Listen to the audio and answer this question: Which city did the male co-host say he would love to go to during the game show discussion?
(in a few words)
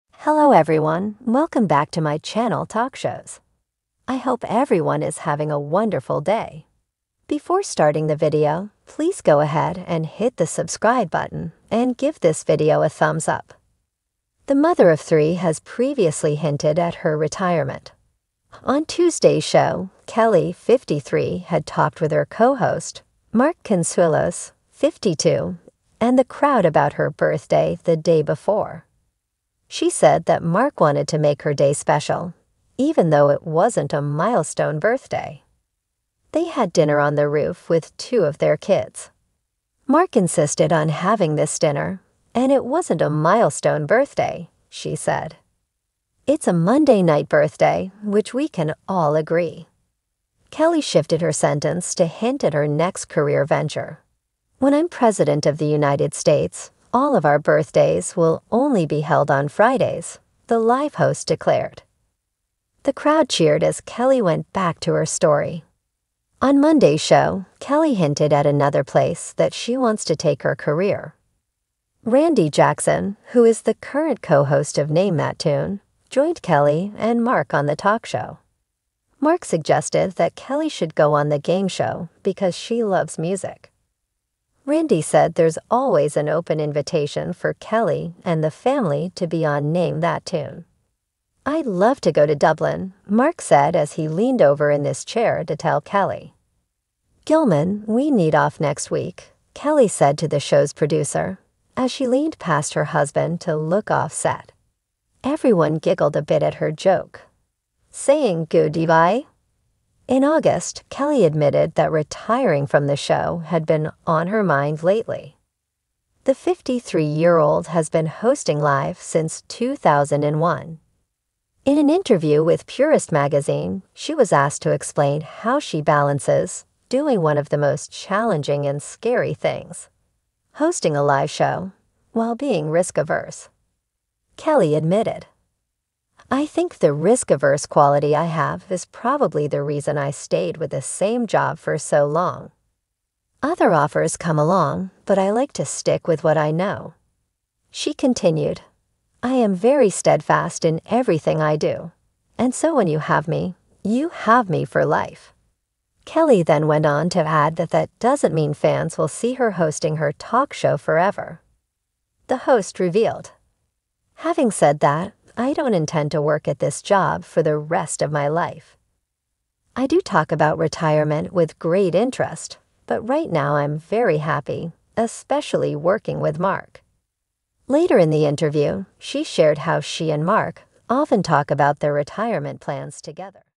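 Dublin.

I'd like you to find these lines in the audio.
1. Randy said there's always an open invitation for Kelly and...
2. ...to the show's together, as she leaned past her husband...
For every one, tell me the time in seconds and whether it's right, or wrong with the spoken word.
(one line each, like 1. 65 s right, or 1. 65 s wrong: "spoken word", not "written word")
1. 84 s right
2. 100 s wrong: "producer", not "together".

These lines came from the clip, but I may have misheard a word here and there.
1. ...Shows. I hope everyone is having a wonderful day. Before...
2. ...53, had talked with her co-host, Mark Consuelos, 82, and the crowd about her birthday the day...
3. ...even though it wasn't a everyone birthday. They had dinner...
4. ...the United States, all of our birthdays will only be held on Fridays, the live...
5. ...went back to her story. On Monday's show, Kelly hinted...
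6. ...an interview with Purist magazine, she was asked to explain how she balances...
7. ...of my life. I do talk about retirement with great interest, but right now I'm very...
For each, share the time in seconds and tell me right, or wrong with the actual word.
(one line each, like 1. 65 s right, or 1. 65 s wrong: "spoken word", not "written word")
1. 2 s right
2. 20 s wrong: "52", not "82"
3. 32 s wrong: "milestone", not "everyone"
4. 55 s right
5. 64 s right
6. 121 s right
7. 168 s right.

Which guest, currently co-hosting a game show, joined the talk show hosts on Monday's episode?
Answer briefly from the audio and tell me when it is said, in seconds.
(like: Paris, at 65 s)
Randy Jackson, at 72 s.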